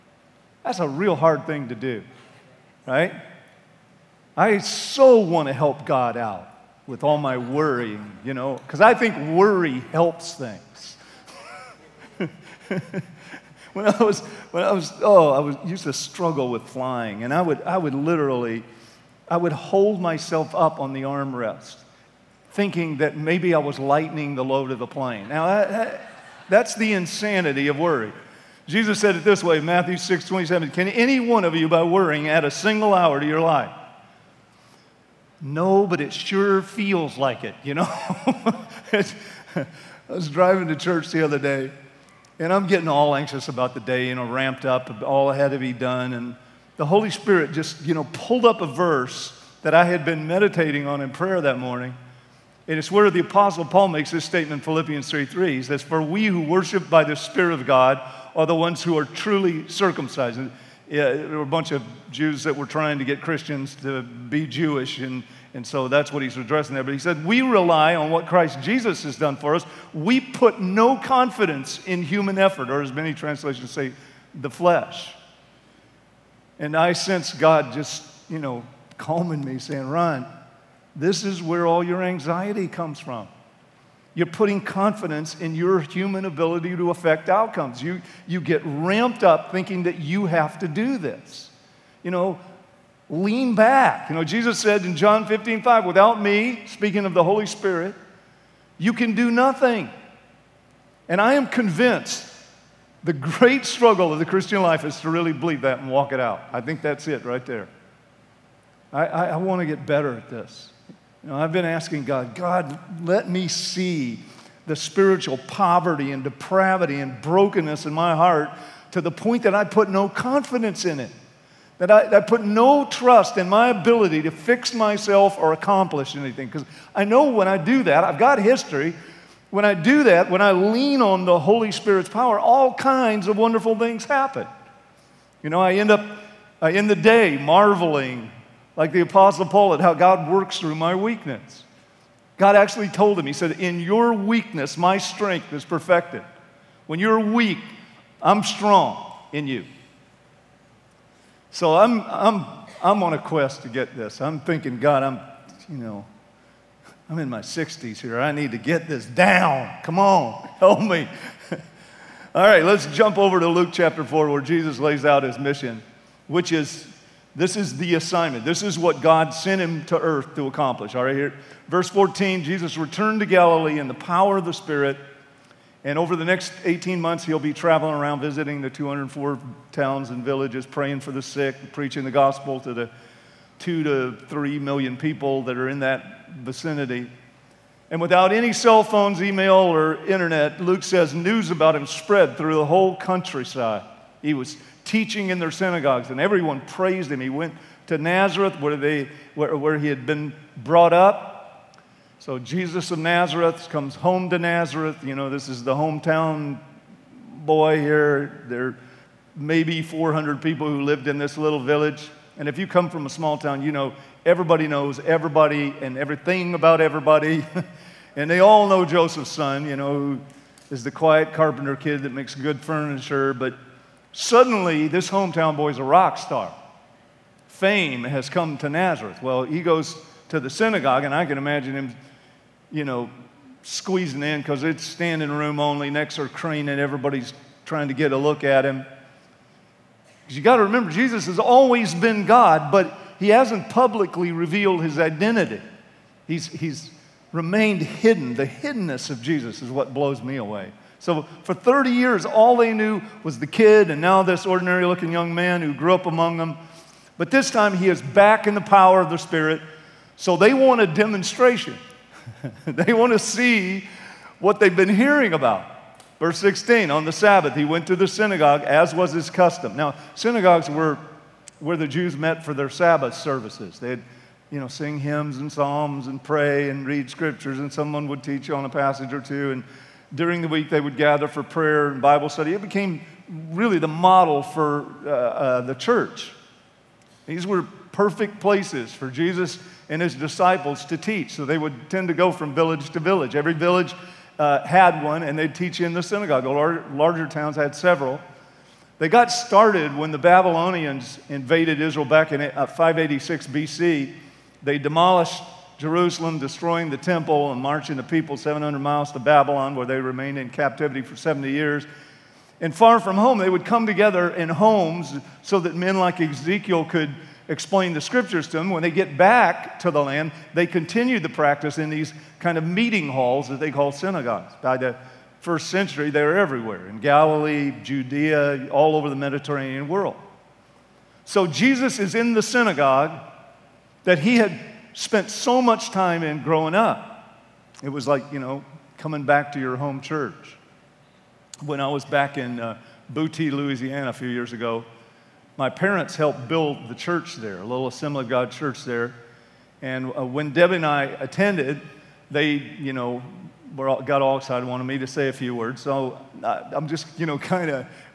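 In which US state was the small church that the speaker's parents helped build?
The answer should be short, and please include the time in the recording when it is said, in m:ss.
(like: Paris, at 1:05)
Louisiana, at 5:43.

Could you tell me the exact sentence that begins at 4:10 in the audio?
So for 30 years, all they knew was the kid and now this ordinary looking young man who grew up among them.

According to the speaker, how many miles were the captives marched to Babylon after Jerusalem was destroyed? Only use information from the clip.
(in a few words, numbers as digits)
700.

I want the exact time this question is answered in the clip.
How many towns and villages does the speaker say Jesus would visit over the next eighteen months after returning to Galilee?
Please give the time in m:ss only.
2:58.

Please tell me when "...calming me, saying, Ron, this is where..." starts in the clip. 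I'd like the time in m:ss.
1:18.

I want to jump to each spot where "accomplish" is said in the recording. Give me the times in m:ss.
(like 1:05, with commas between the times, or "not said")
2:05, 2:50.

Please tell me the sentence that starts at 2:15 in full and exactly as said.
You know, I end up I end the day marveling, like the Apostle Paul, at how God works through my weakness.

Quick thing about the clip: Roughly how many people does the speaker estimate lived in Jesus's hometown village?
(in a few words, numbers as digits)
400.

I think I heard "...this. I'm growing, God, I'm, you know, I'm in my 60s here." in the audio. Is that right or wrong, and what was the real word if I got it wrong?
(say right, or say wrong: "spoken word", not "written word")
wrong: "thinking", not "growing".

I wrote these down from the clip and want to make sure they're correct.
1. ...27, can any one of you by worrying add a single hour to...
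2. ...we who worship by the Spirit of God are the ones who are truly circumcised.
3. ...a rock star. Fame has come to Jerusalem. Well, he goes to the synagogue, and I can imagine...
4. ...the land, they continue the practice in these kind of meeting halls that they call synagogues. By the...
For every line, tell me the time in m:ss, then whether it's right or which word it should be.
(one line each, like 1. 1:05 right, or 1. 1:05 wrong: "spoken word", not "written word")
1. 0:30 right
2. 0:56 right
3. 3:45 wrong: "Nazareth", not "Jerusalem"
4. 5:19 right.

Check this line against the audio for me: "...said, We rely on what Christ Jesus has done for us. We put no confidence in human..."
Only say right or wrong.
right.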